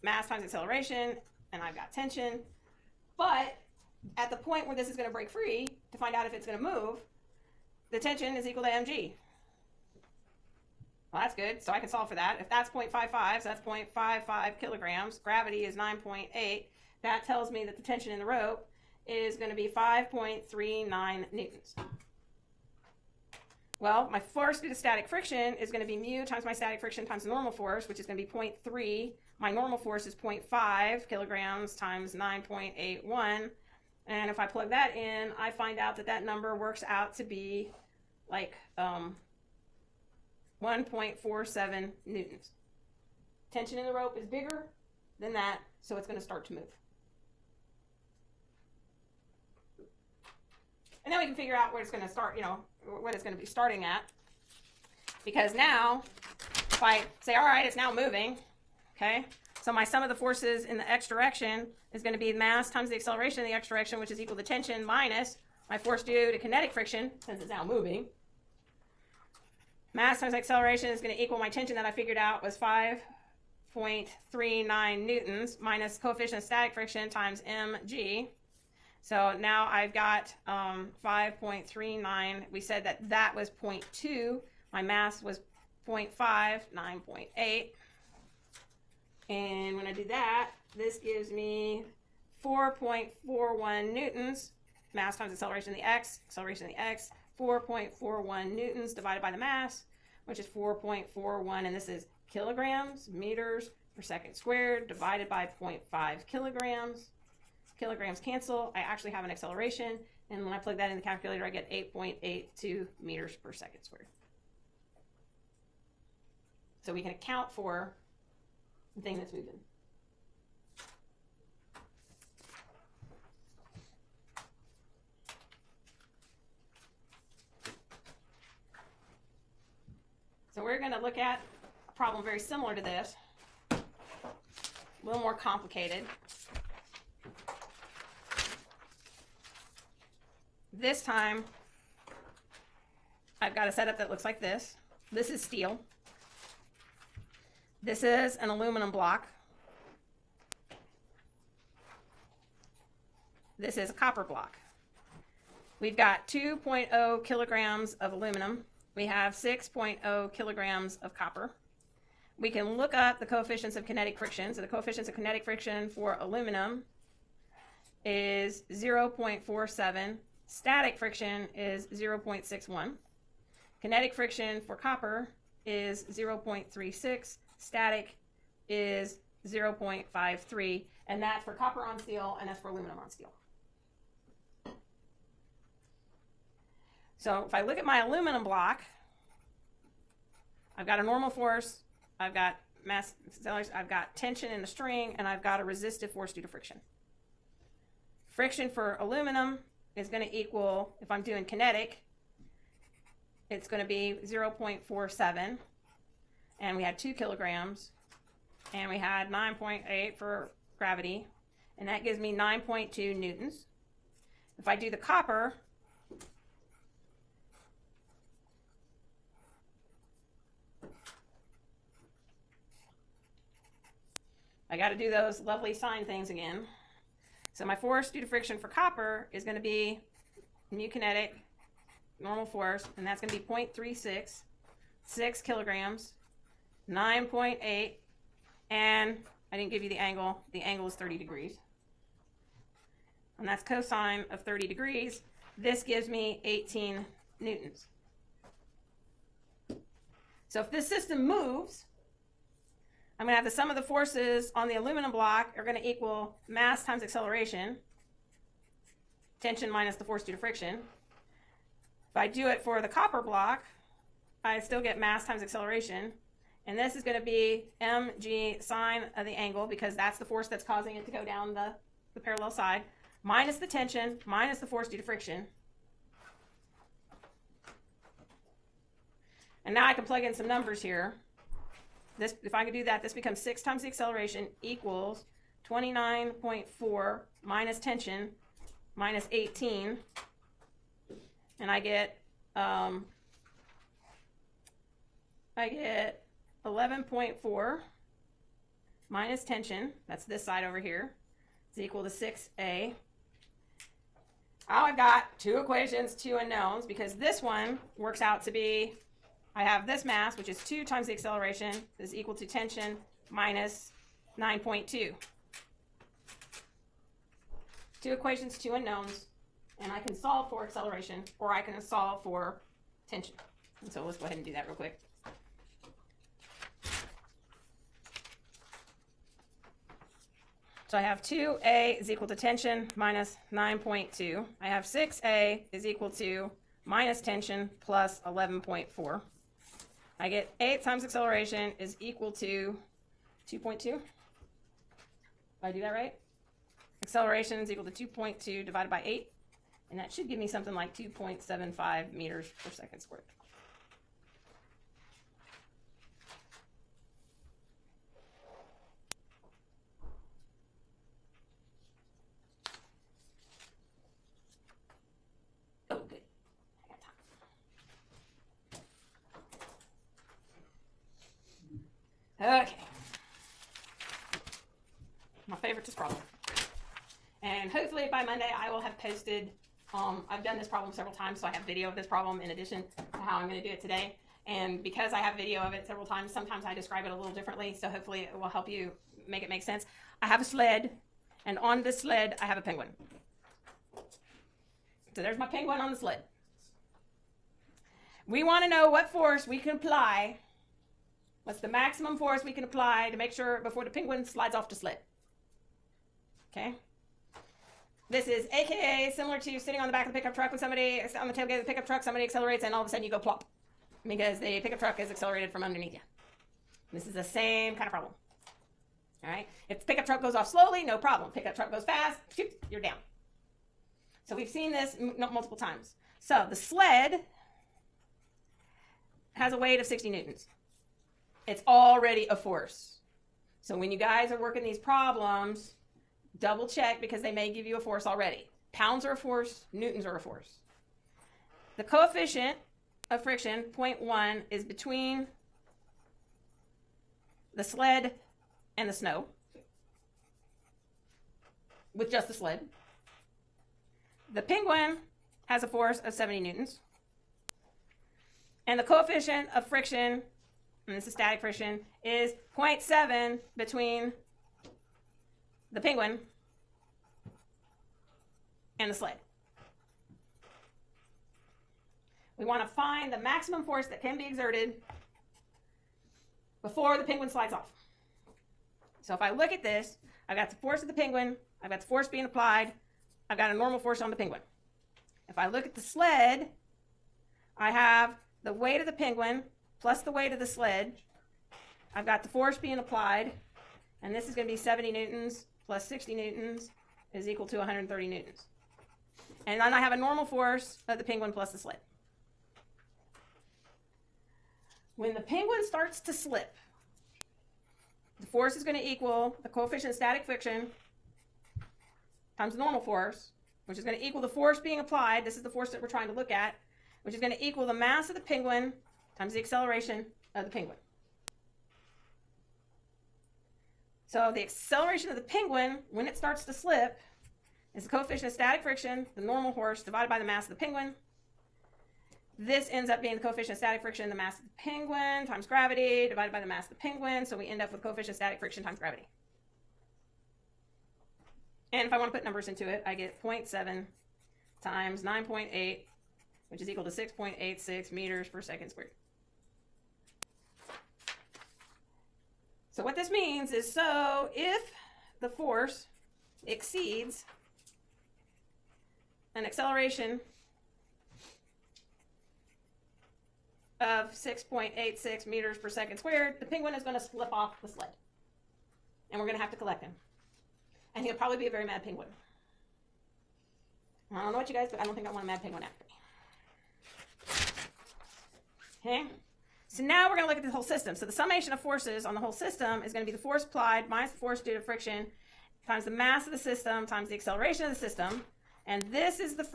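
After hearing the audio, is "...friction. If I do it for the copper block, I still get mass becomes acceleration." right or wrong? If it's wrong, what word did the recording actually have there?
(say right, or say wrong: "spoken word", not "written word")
wrong: "times", not "becomes".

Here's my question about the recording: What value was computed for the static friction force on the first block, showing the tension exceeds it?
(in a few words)
1.47 newtons.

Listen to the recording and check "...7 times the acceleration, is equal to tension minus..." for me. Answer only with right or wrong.
wrong.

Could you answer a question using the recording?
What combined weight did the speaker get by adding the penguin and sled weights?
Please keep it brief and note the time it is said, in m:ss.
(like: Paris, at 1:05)
130 newtons, at 8:17.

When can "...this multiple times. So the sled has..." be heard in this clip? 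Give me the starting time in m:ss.
7:04.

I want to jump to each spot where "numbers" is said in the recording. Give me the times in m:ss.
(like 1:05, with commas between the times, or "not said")
0:36, 4:40, 9:02.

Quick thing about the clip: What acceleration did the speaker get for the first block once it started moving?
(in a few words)
8.82 meters per second squared.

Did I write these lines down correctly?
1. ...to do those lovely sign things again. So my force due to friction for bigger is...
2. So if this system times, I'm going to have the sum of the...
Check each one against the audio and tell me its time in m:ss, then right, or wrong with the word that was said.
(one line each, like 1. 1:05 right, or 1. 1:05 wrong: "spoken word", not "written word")
1. 3:44 wrong: "copper", not "bigger"
2. 4:10 wrong: "moves", not "times".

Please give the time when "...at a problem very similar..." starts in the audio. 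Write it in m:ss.
2:11.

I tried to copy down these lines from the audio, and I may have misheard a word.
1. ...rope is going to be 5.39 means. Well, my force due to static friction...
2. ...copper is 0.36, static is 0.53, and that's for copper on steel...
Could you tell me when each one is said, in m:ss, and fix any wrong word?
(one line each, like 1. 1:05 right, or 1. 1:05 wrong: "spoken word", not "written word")
1. 0:18 wrong: "newtons", not "means"
2. 2:54 right.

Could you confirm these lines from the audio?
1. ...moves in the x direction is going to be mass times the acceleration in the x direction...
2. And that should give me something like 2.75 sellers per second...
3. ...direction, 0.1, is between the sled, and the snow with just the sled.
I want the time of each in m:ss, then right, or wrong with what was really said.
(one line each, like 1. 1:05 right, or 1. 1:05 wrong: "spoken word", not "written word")
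1. 1:00 wrong: "forces", not "moves"
2. 5:49 wrong: "meters", not "sellers"
3. 7:23 wrong: "friction", not "direction".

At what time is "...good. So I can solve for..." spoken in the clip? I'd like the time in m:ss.
0:11.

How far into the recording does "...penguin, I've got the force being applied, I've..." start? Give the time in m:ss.
8:00.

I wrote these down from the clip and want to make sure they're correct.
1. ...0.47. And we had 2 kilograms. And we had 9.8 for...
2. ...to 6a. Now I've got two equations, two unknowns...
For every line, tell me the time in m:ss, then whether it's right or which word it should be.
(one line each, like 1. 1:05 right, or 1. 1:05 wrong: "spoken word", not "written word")
1. 3:24 right
2. 5:02 right.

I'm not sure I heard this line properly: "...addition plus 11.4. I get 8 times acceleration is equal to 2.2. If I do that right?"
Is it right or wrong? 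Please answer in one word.
wrong.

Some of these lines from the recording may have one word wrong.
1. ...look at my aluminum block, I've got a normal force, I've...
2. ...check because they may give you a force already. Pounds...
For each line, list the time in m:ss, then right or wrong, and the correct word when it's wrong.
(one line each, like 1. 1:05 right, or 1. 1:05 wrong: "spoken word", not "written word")
1. 3:07 right
2. 7:16 right.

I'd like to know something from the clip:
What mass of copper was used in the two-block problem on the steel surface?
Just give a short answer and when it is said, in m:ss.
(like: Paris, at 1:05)
6.0 kilograms, at 2:39.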